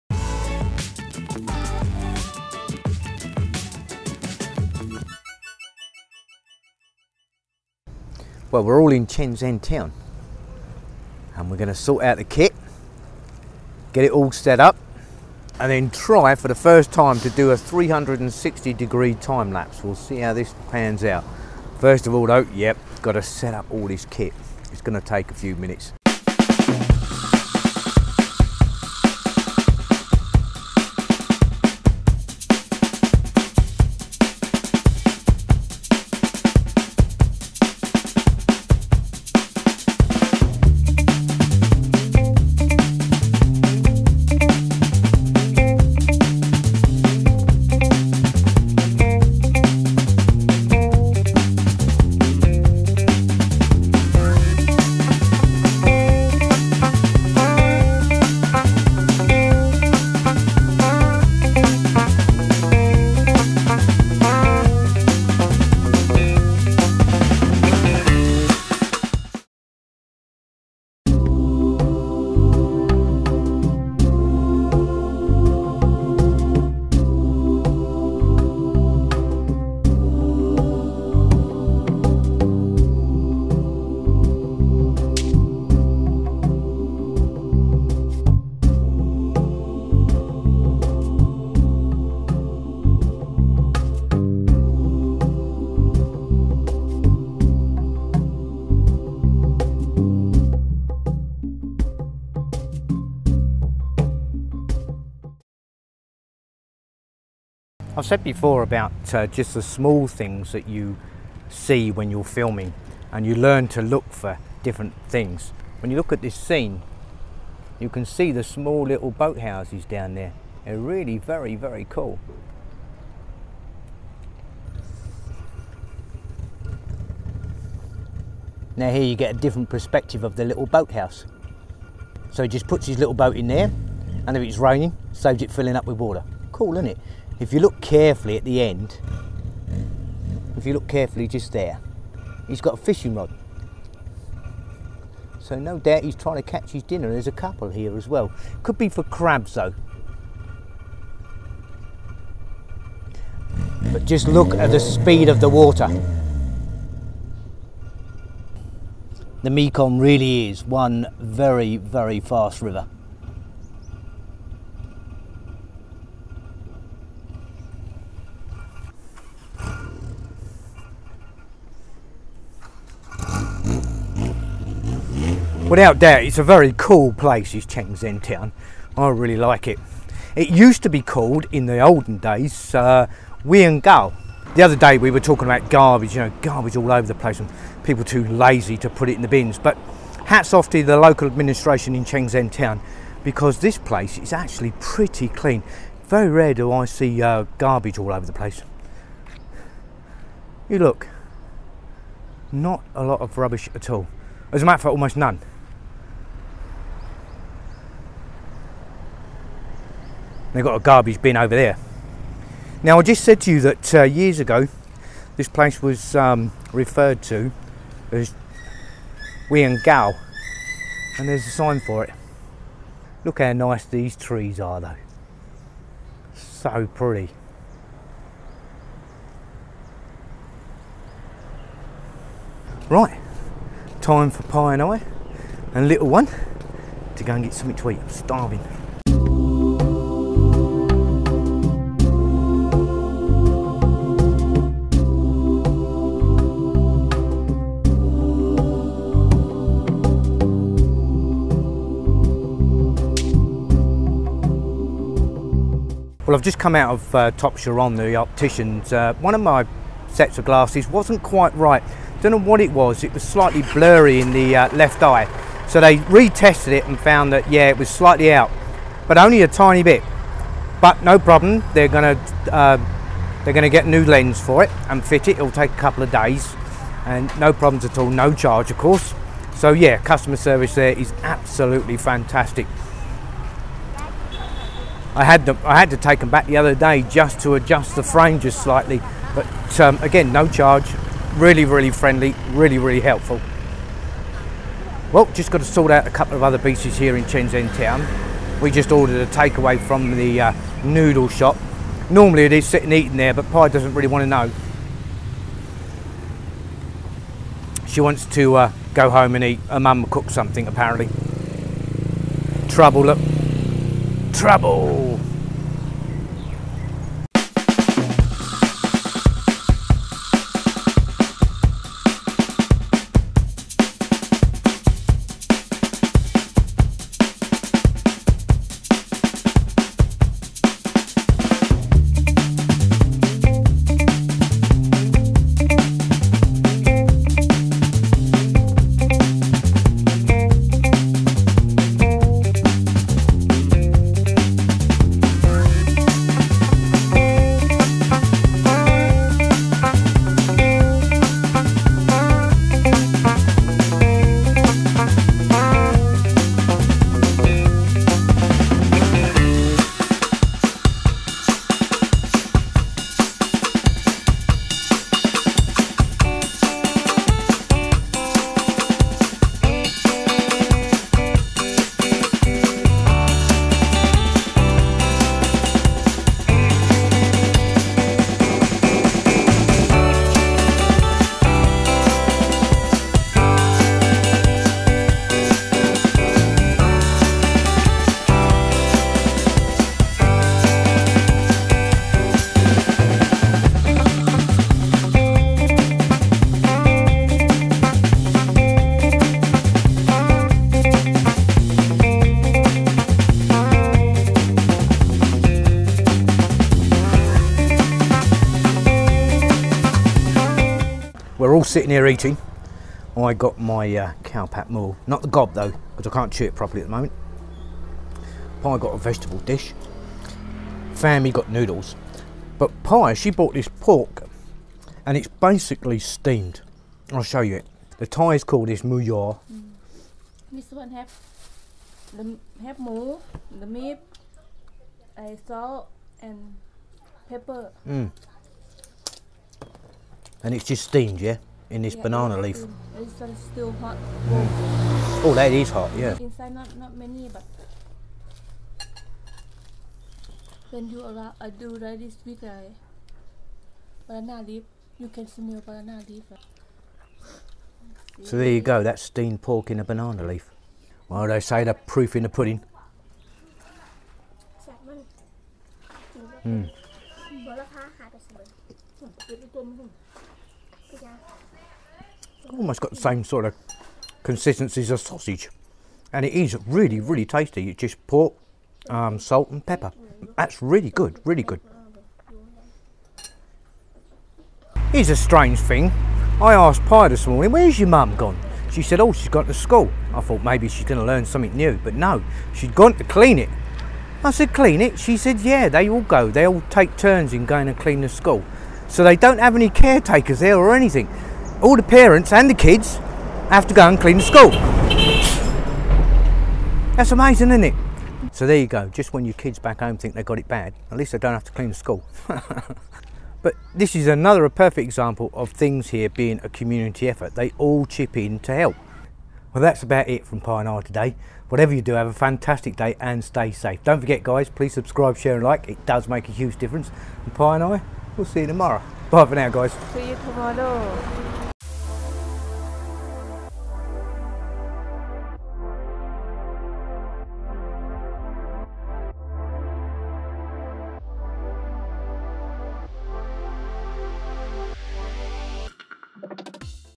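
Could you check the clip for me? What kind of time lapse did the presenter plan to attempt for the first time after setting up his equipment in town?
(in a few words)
360 degree.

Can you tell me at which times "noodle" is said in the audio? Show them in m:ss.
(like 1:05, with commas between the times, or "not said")
5:00, 7:01.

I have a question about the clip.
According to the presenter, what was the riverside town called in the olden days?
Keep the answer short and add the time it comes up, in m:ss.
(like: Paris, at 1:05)
Gao, at 3:39.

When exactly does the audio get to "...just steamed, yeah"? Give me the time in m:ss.
7:20.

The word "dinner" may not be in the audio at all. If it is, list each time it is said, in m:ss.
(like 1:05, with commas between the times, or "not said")
2:26.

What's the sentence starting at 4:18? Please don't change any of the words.
Uh, one of my sets of glasses wasn't quite right.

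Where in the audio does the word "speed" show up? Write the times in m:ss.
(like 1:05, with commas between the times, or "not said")
2:34.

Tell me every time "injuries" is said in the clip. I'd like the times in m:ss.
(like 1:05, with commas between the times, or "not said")
not said.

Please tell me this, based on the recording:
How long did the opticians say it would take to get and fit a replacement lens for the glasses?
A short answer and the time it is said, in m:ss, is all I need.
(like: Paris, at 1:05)
a couple of days, at 4:35.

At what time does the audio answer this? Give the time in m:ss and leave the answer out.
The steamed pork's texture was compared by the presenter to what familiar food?
7:54.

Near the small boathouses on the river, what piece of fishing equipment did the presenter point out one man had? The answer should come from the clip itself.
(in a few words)
fishing rod.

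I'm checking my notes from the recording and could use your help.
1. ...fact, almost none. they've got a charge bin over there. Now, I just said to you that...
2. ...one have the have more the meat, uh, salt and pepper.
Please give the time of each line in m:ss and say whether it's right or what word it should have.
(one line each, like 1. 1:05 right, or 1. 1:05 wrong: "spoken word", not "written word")
1. 3:24 wrong: "garbage", not "charge"
2. 7:10 right.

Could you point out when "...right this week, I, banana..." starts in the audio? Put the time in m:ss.
7:31.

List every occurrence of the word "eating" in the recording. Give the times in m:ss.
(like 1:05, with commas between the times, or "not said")
5:02, 6:52.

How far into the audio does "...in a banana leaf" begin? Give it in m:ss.
7:39.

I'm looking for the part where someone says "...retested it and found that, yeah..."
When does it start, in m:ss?
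4:25.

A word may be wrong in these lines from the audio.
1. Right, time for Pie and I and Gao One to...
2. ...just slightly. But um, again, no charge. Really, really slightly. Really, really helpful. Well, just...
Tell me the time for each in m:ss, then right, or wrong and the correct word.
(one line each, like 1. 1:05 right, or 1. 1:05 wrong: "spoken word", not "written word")
1. 3:52 wrong: "Little", not "Gao"
2. 4:48 wrong: "friendly", not "slightly".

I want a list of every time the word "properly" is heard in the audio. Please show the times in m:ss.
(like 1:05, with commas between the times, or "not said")
6:56.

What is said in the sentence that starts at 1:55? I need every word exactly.
When you look at this scene, you can see the small little boathouses down there.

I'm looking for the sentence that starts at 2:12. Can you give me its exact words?
So he just puts his little boat in there and if it's raining, saves it filling up with water.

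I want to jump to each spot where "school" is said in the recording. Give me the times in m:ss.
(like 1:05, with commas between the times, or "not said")
8:09, 8:18, 8:24, 8:31.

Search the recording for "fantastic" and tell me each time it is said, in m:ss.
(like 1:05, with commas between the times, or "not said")
4:41, 8:42.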